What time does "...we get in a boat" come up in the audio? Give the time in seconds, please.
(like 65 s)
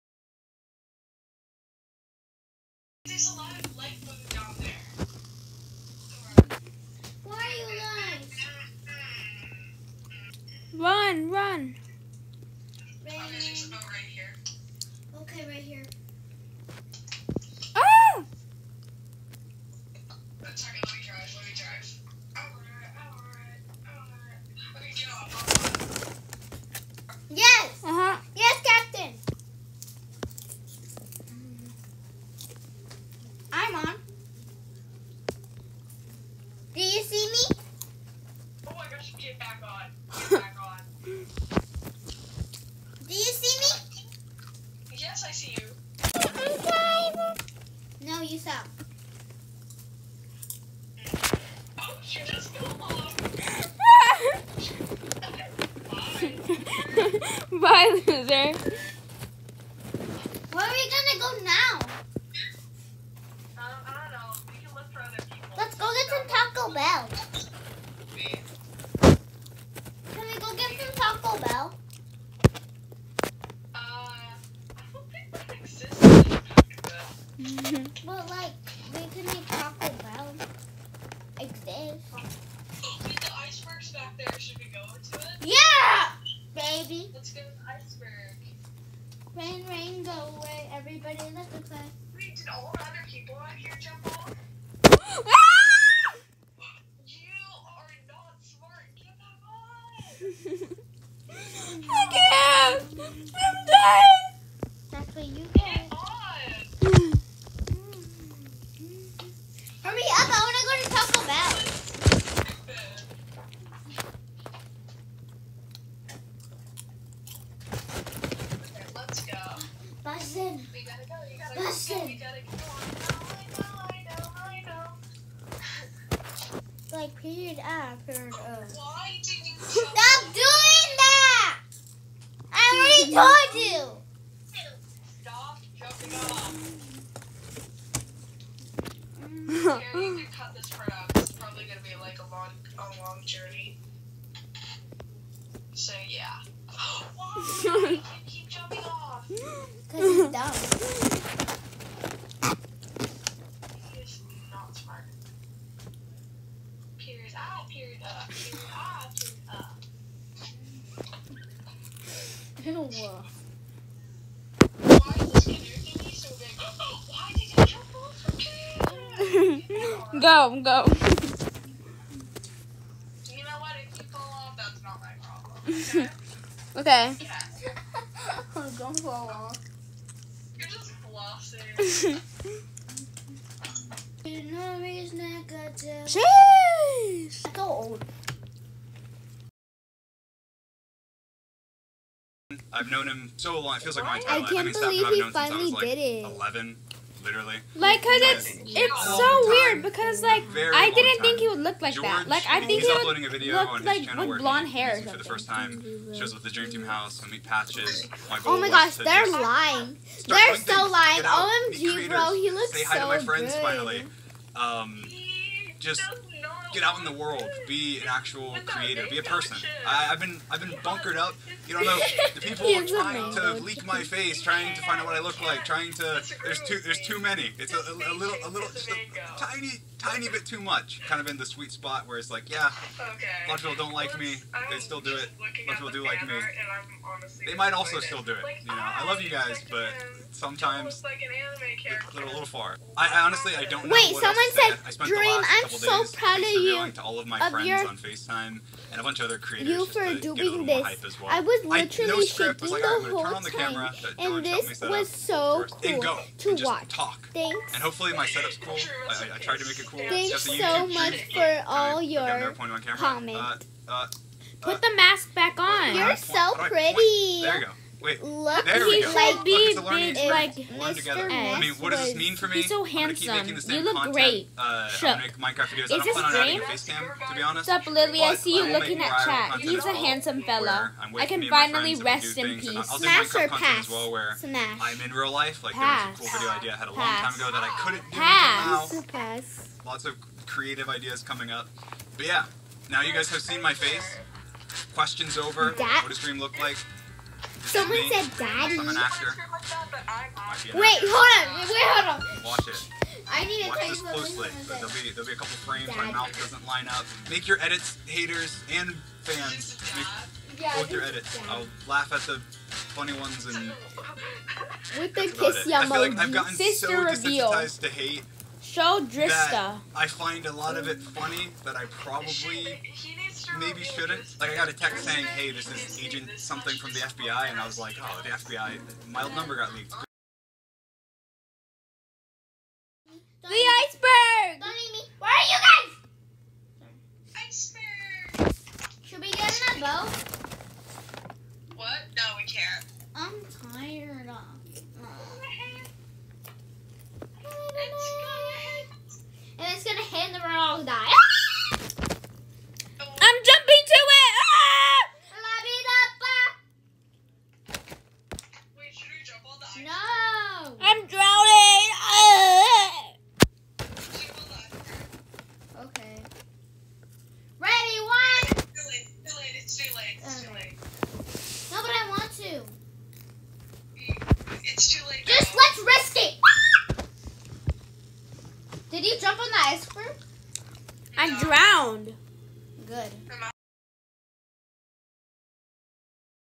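339 s.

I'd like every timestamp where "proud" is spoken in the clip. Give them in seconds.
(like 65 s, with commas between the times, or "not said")
246 s.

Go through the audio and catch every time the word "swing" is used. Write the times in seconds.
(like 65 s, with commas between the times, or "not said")
not said.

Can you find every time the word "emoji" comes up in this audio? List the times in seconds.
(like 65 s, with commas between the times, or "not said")
315 s.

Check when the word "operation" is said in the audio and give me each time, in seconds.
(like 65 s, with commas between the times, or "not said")
not said.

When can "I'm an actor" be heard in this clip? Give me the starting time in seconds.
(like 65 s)
298 s.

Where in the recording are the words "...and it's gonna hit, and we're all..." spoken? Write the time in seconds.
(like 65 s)
349 s.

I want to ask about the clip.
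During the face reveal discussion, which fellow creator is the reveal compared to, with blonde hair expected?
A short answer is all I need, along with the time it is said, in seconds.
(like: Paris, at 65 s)
George, at 201 s.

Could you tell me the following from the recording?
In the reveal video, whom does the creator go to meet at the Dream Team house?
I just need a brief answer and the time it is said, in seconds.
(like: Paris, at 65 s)
Patches, at 207 s.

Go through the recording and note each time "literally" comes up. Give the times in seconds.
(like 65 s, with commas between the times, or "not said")
197 s, 251 s.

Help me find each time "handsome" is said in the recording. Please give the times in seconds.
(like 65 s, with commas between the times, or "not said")
272 s, 279 s.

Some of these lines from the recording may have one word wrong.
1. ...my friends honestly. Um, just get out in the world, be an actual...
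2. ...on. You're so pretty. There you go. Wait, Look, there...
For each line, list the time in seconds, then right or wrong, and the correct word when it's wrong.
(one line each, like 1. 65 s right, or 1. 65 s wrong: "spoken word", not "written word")
1. 213 s wrong: "finally", not "honestly"
2. 265 s right.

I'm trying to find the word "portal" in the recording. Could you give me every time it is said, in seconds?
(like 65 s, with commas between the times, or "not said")
not said.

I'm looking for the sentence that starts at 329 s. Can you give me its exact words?
My number got leaked." The iceberg.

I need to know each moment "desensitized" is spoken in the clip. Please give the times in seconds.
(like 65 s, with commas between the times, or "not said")
317 s.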